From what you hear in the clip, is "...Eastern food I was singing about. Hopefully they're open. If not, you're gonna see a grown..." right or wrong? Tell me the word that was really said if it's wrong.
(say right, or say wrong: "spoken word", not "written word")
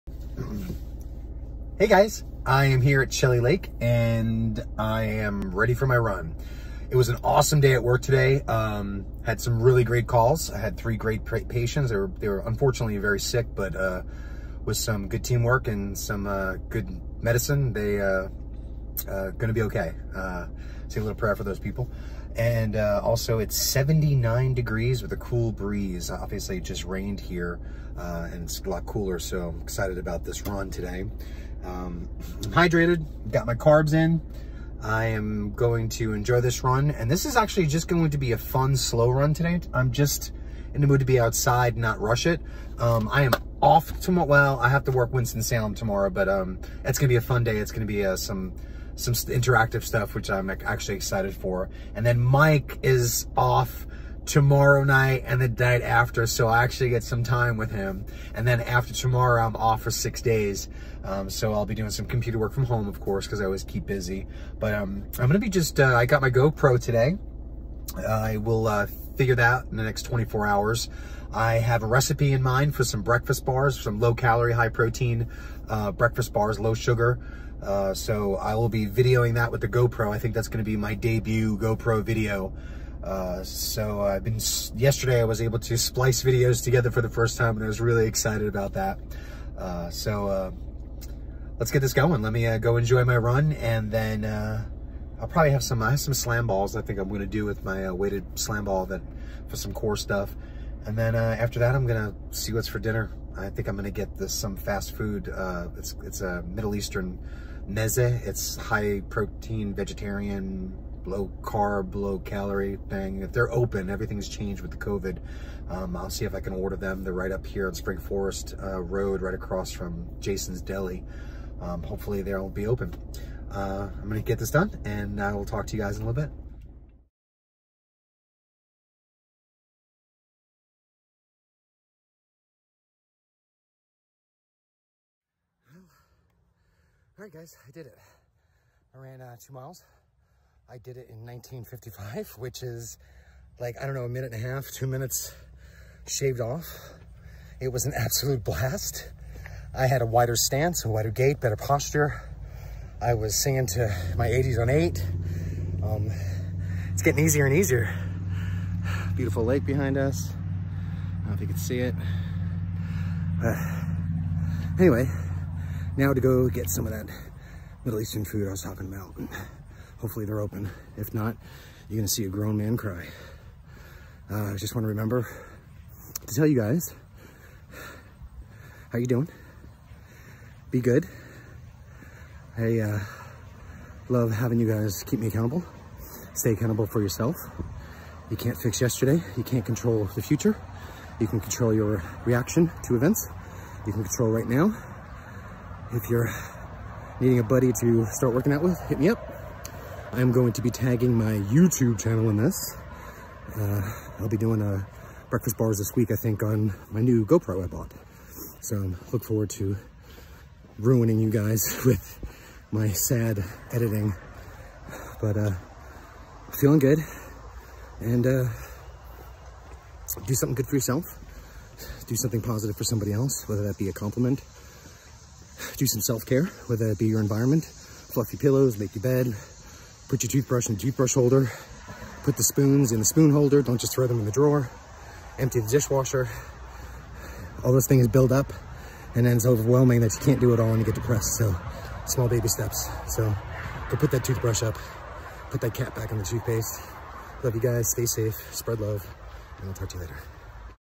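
wrong: "talking", not "singing".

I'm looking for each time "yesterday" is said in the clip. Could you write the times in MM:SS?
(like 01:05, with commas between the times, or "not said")
01:24, 03:08.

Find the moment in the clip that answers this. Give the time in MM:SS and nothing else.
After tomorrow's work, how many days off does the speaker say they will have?
00:59.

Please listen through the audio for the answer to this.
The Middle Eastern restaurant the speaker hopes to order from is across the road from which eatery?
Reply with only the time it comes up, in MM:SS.
02:00.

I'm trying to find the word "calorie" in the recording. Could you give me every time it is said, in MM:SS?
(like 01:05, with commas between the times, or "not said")
01:14, 01:52.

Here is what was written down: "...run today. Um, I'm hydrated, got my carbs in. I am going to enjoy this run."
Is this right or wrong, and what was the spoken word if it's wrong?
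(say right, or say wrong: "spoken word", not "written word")
right.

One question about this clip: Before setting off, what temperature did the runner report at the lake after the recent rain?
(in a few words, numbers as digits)
79 degrees.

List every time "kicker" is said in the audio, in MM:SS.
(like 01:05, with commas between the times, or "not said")
not said.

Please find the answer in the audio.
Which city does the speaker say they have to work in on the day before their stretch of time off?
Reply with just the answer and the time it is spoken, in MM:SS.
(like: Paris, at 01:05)
Winston-Salem, at 00:45.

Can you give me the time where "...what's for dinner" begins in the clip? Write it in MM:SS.
01:42.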